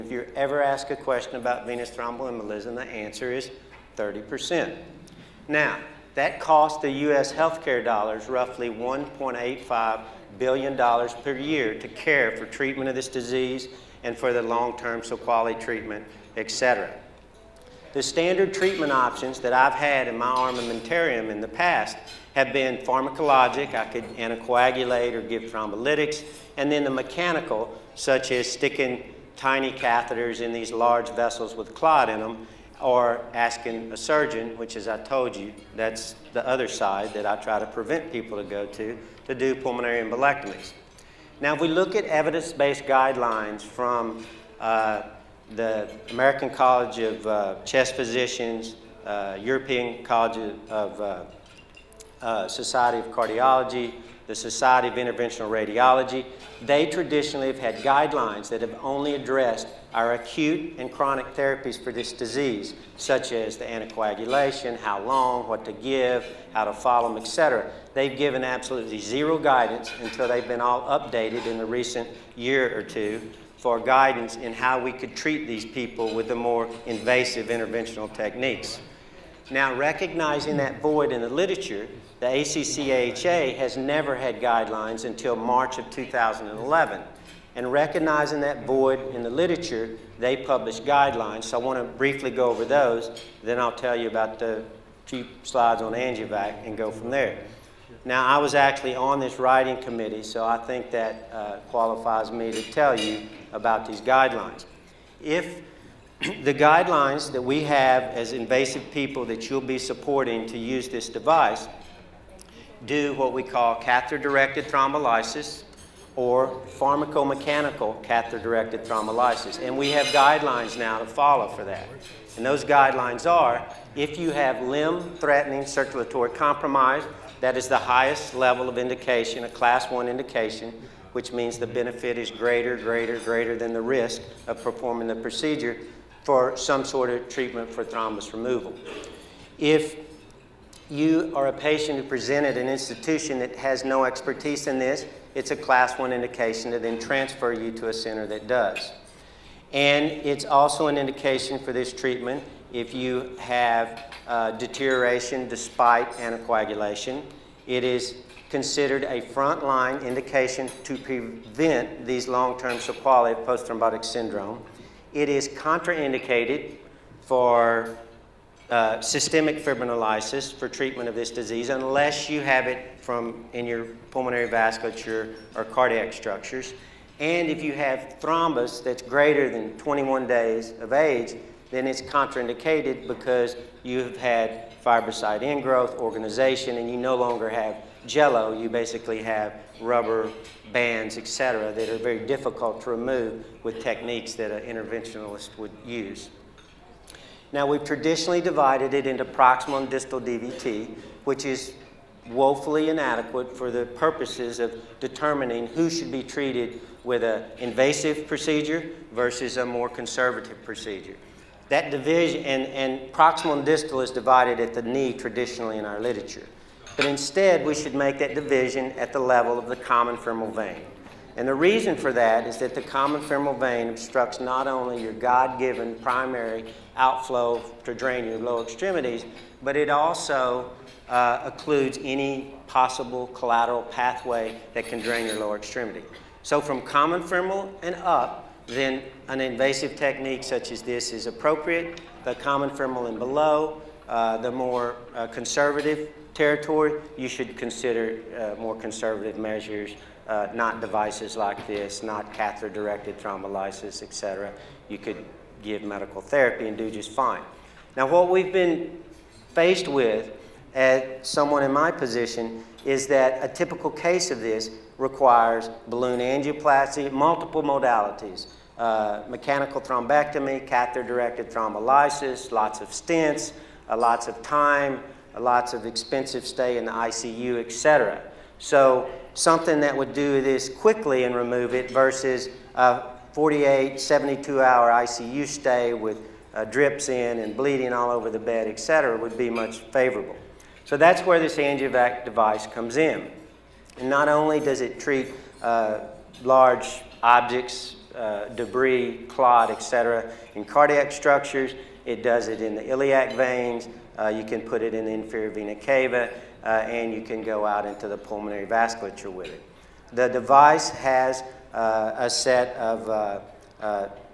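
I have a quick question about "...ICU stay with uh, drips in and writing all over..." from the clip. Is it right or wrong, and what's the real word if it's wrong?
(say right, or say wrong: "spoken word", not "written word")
wrong: "bleeding", not "writing".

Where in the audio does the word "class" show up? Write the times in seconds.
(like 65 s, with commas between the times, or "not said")
129 s, 145 s.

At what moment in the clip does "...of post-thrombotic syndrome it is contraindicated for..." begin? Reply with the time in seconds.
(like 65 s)
163 s.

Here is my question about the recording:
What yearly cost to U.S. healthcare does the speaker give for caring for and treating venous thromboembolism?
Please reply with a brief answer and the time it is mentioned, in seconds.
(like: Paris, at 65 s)
$1.85 billion, at 8 s.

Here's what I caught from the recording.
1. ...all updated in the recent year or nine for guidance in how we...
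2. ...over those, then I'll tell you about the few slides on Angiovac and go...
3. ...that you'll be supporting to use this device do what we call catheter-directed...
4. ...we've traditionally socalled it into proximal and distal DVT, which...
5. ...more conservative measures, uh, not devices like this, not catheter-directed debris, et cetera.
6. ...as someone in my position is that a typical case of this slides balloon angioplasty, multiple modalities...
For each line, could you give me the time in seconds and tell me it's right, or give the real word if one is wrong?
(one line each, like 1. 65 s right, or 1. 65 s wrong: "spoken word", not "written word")
1. 70 s wrong: "two", not "nine"
2. 92 s right
3. 109 s right
4. 197 s wrong: "divided", not "socalled"
5. 248 s wrong: "thrombolysis", not "debris"
6. 260 s wrong: "requires", not "slides".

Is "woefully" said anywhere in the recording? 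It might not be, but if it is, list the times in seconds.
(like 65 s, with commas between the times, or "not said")
202 s.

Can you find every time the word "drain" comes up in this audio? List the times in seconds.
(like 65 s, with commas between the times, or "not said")
227 s, 234 s.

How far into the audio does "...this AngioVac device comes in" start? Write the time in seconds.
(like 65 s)
291 s.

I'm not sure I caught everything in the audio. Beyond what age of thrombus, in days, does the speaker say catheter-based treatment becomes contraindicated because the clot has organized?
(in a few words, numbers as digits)
21 days.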